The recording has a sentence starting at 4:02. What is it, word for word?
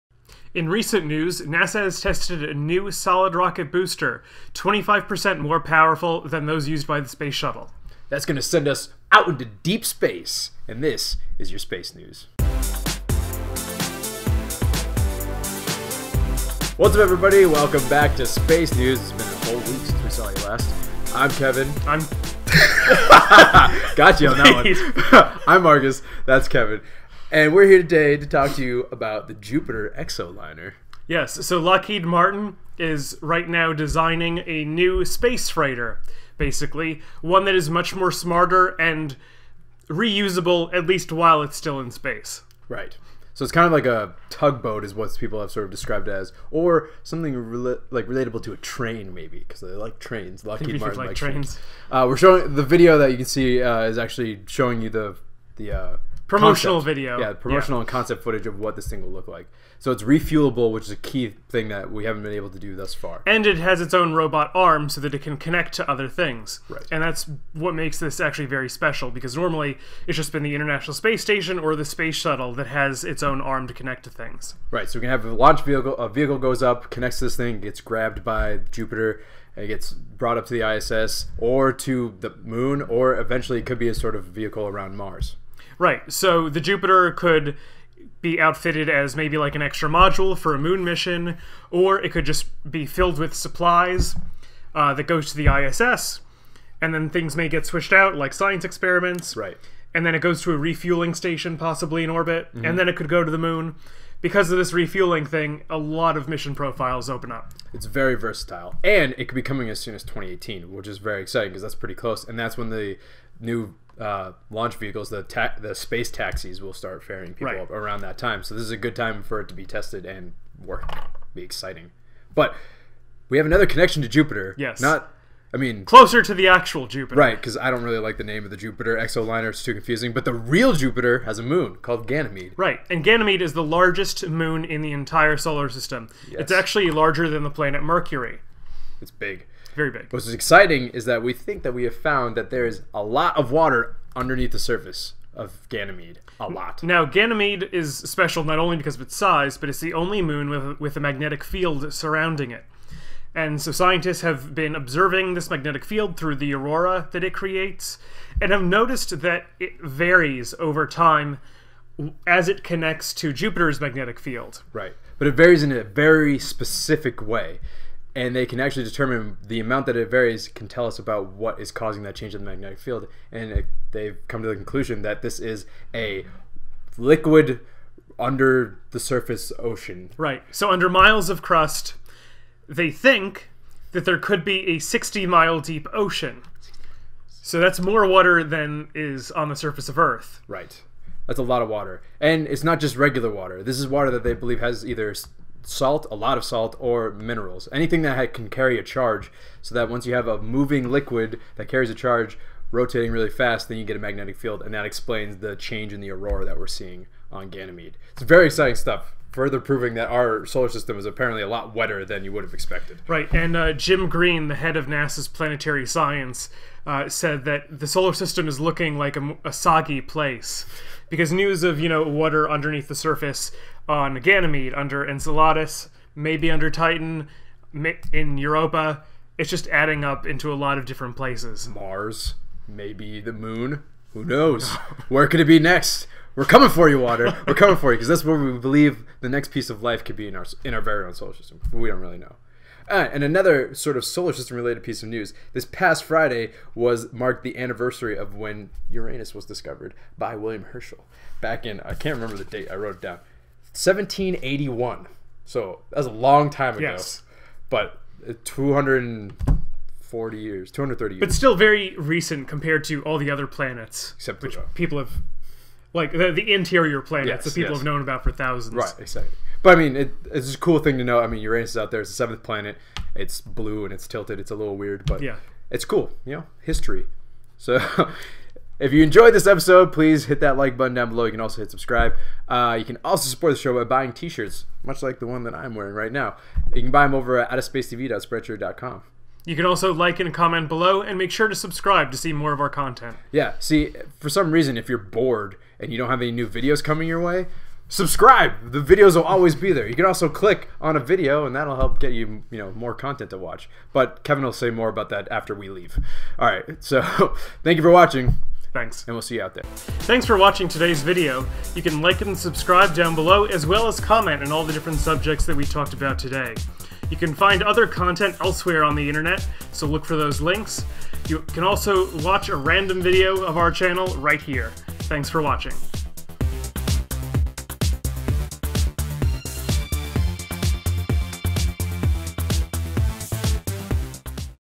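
and another sort of solar system related piece of news.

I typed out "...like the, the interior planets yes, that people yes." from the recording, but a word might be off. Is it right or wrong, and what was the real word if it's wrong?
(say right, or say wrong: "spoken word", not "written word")
right.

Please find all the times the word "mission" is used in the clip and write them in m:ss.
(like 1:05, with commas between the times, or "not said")
1:30, 1:46.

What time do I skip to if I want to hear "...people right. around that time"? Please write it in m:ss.
1:57.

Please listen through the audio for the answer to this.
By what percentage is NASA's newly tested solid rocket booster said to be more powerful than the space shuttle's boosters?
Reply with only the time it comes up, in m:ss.
0:04.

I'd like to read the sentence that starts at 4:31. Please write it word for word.
I mean, Uranus is out there; it's the seventh planet.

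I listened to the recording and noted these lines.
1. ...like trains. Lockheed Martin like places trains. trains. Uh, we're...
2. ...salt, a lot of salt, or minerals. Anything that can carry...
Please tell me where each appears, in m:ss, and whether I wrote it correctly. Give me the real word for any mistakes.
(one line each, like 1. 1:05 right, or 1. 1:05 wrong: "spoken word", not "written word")
1. 0:49 wrong: "likes", not "places"
2. 3:15 right.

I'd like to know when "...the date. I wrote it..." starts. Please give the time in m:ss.
4:12.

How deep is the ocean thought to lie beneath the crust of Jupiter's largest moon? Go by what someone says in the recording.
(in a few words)
60 miles.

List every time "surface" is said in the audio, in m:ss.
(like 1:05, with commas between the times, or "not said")
2:24, 2:58, 3:09, 3:42.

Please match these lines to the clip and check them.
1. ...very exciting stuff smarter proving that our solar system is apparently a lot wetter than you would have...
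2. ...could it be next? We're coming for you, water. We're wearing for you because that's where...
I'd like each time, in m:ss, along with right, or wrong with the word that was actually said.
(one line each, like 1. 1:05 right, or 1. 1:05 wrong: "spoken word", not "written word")
1. 3:28 wrong: "further", not "smarter"
2. 3:55 wrong: "coming", not "wearing".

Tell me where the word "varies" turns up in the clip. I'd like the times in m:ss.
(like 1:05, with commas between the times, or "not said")
2:39, 2:45, 2:50.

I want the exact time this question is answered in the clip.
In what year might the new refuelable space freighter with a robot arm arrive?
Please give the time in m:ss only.
1:50.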